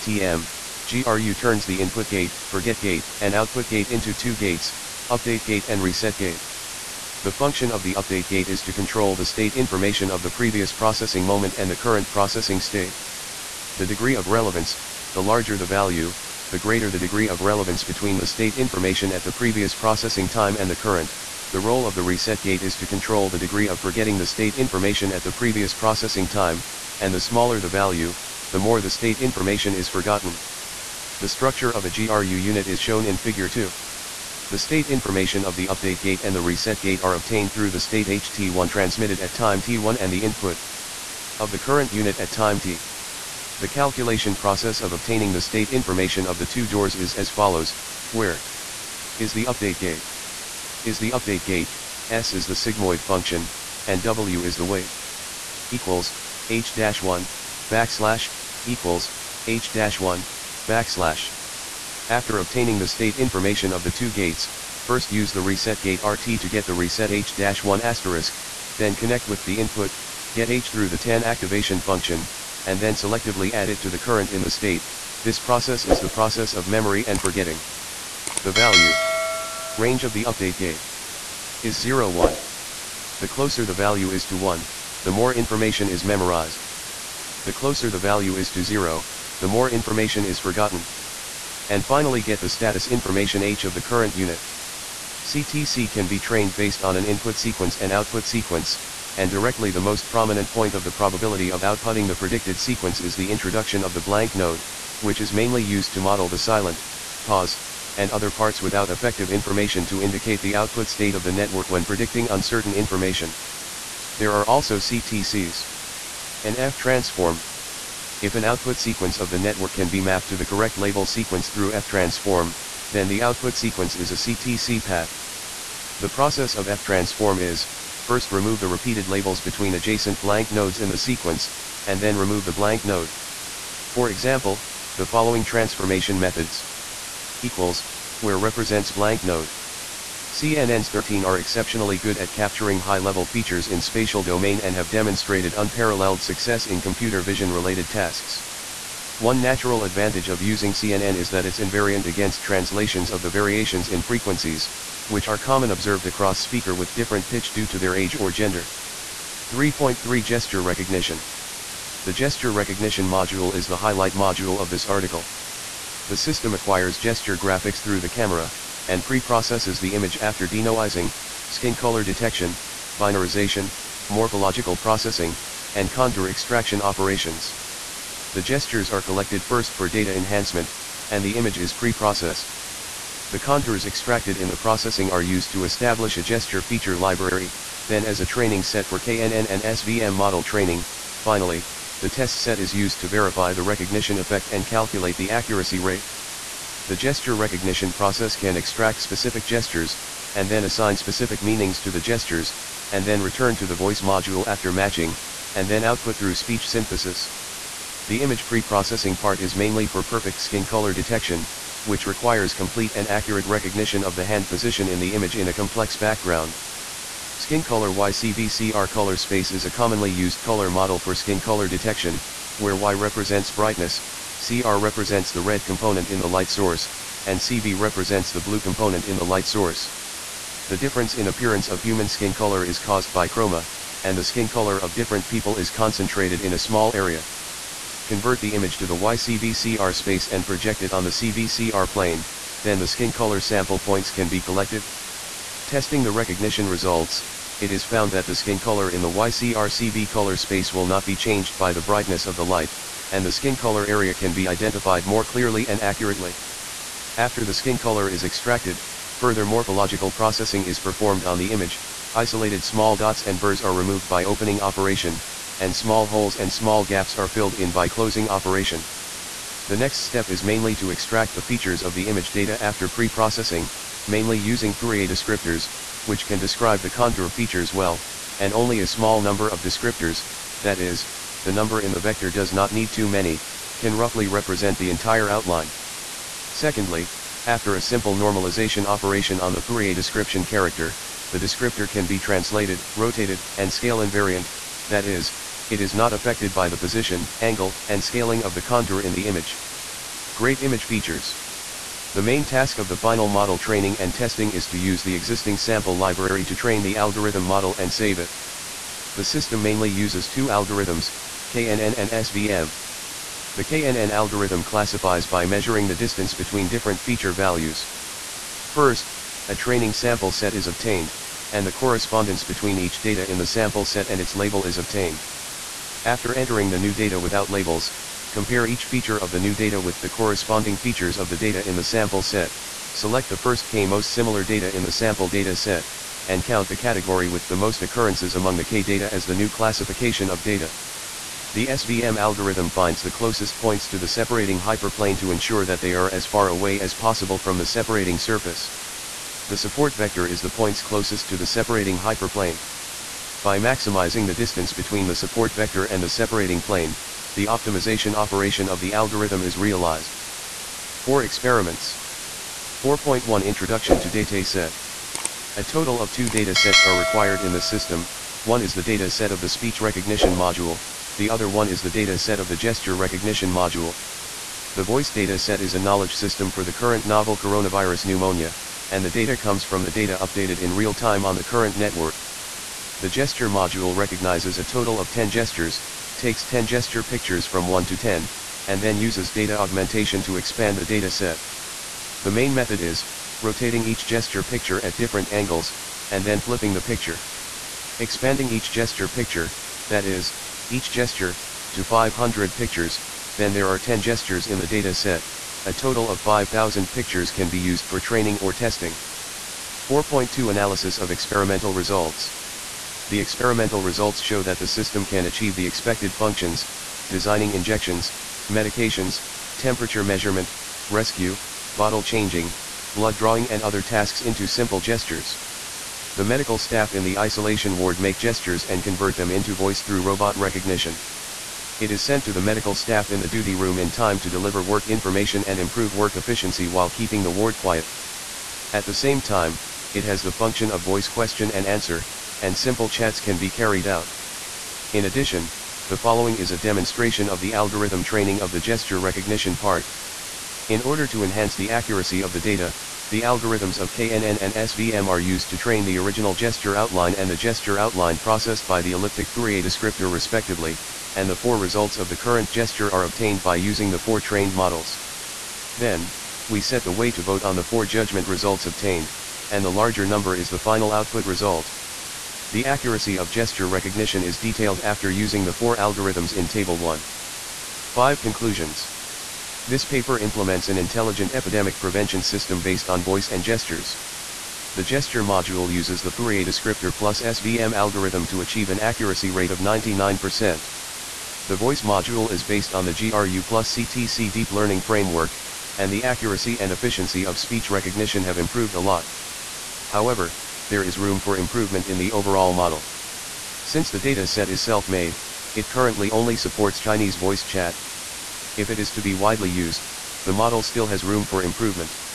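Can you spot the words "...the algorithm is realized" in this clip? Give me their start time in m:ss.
5:58.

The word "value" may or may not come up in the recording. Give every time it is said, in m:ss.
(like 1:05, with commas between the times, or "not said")
0:15, 0:27, 1:18, 1:23, 1:27, 5:17.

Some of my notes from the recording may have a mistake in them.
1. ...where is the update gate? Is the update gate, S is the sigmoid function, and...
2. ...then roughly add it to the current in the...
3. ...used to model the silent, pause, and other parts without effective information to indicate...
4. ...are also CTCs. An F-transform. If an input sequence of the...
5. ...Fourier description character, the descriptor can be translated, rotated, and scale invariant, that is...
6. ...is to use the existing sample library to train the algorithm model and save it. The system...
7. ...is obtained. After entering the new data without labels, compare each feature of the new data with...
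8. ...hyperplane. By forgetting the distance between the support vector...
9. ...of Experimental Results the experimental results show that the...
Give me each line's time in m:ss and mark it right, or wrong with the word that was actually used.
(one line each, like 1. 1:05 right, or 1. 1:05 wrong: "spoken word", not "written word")
1. 0:48 right
2. 1:12 wrong: "selectively", not "roughly"
3. 1:45 right
4. 1:54 wrong: "output", not "input"
5. 4:49 right
6. 5:04 right
7. 5:24 right
8. 5:51 wrong: "maximizing", not "forgetting"
9. 6:50 right.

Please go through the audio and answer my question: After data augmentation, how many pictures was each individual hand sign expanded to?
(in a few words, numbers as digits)
500.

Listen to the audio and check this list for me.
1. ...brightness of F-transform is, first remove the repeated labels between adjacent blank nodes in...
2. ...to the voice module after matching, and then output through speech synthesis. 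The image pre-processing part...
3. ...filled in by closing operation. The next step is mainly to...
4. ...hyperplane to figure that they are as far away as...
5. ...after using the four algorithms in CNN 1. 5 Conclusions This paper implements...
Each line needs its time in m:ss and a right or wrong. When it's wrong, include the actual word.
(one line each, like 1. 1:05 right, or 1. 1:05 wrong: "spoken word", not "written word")
1. 2:06 wrong: "process", not "brightness"
2. 3:23 right
3. 4:27 right
4. 5:44 wrong: "ensure", not "figure"
5. 7:54 wrong: "Table", not "CNN".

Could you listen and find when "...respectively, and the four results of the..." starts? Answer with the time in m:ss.
7:40.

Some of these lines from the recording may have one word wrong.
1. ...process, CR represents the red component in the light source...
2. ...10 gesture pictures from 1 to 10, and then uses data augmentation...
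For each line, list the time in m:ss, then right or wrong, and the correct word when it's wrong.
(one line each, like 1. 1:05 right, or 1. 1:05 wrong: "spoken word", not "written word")
1. 3:43 wrong: "brightness", not "process"
2. 6:26 right.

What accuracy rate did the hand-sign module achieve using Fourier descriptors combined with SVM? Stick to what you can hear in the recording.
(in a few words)
99%.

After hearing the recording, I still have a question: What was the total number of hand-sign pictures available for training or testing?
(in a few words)
5000.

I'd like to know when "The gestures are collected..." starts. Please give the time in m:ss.
2:58.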